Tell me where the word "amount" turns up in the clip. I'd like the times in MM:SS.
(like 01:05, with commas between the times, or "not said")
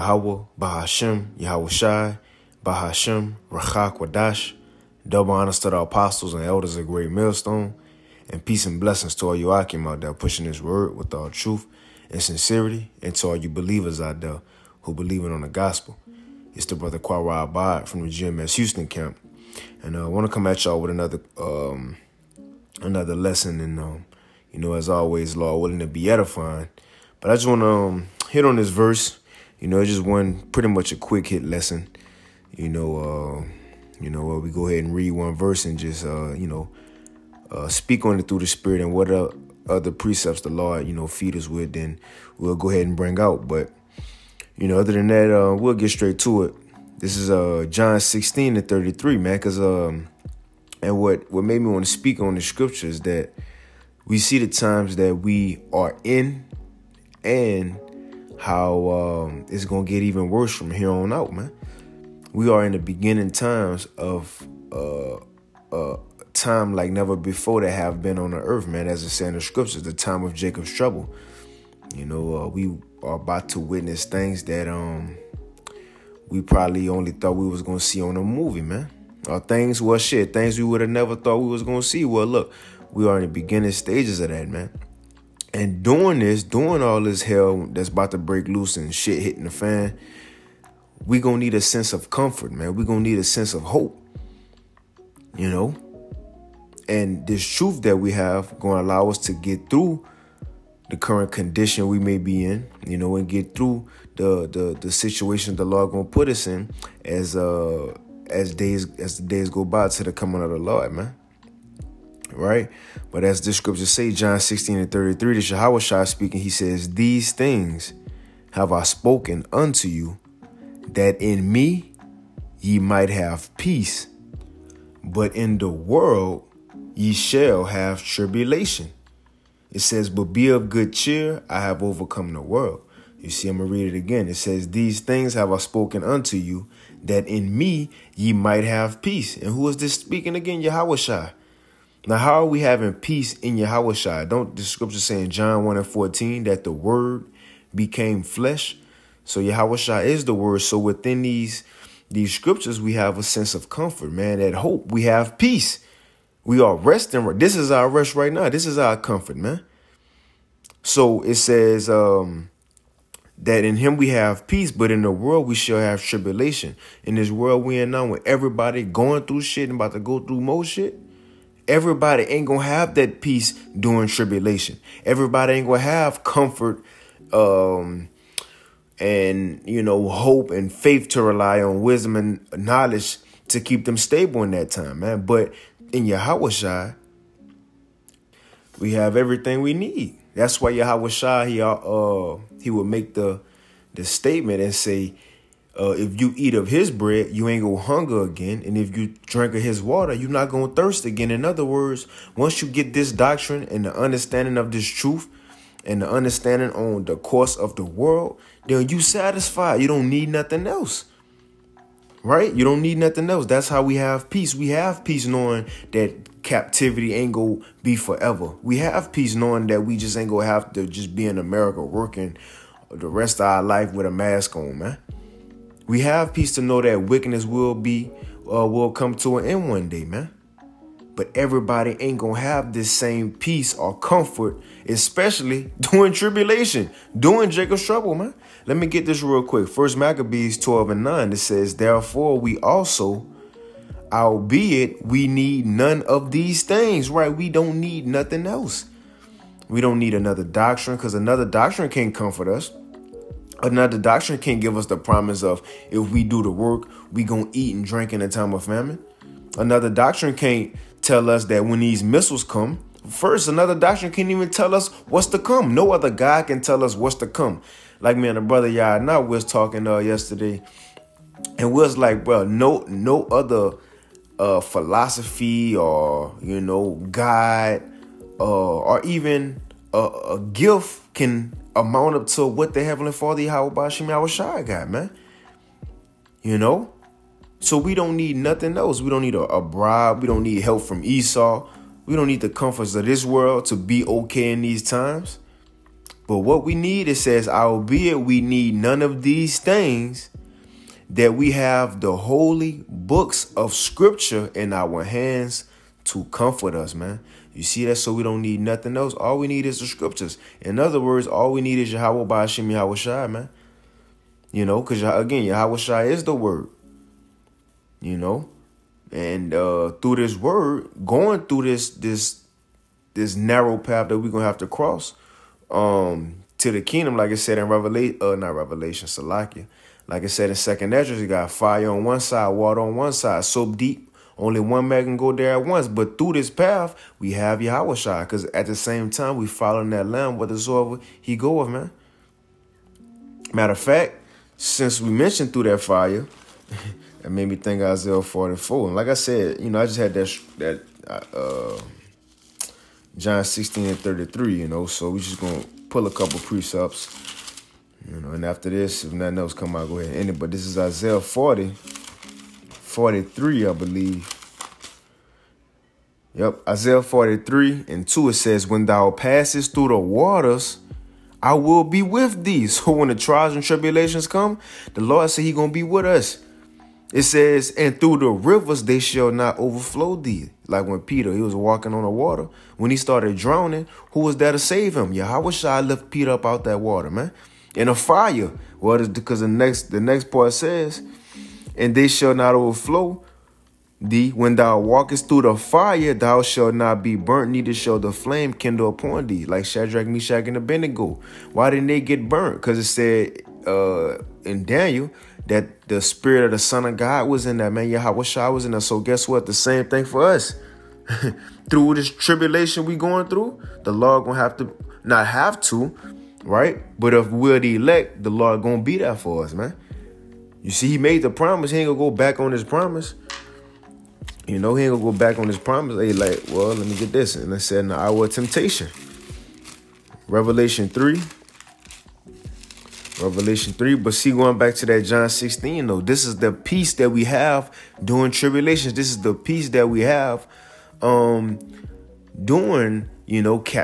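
04:41.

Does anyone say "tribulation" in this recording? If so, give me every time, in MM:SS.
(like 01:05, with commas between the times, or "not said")
02:08, 02:46, 02:54, 03:56, 06:13, 06:52, 07:18.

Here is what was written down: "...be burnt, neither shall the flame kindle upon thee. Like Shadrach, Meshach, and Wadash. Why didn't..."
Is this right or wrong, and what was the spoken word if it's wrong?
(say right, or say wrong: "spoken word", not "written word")
wrong: "Abednego", not "Wadash".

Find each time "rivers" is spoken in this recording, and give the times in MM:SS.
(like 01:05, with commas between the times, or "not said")
06:18.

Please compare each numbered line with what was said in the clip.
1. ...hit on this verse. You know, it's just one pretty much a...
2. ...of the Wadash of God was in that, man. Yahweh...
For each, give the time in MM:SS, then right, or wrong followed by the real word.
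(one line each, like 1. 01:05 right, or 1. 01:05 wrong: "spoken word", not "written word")
1. 00:28 right
2. 06:46 wrong: "Son", not "Wadash".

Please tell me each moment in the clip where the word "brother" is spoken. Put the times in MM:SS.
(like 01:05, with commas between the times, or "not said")
00:16, 04:28.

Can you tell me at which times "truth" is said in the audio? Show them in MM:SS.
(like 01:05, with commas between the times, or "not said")
00:11, 01:37, 03:24.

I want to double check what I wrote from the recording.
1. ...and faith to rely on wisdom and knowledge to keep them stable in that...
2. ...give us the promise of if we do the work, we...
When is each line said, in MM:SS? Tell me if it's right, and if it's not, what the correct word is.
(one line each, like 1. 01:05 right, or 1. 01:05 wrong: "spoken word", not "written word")
1. 03:00 right
2. 04:14 right.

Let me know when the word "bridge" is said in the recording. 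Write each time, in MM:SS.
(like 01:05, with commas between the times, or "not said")
not said.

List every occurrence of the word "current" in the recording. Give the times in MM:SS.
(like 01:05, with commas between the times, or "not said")
01:40.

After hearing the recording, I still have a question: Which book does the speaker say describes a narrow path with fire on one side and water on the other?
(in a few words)
Second Ezra.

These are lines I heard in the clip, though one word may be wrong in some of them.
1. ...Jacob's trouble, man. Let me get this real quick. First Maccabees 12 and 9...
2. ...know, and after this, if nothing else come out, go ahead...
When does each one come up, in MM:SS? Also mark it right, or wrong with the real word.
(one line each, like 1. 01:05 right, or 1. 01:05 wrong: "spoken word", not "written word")
1. 03:57 right
2. 05:58 right.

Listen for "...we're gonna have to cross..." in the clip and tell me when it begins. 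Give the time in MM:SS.
05:24.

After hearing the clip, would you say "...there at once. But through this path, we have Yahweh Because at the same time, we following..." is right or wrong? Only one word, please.
right.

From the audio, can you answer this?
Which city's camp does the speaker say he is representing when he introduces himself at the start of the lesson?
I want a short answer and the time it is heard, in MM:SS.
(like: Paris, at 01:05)
Houston, at 00:18.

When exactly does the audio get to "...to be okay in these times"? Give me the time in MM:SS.
04:53.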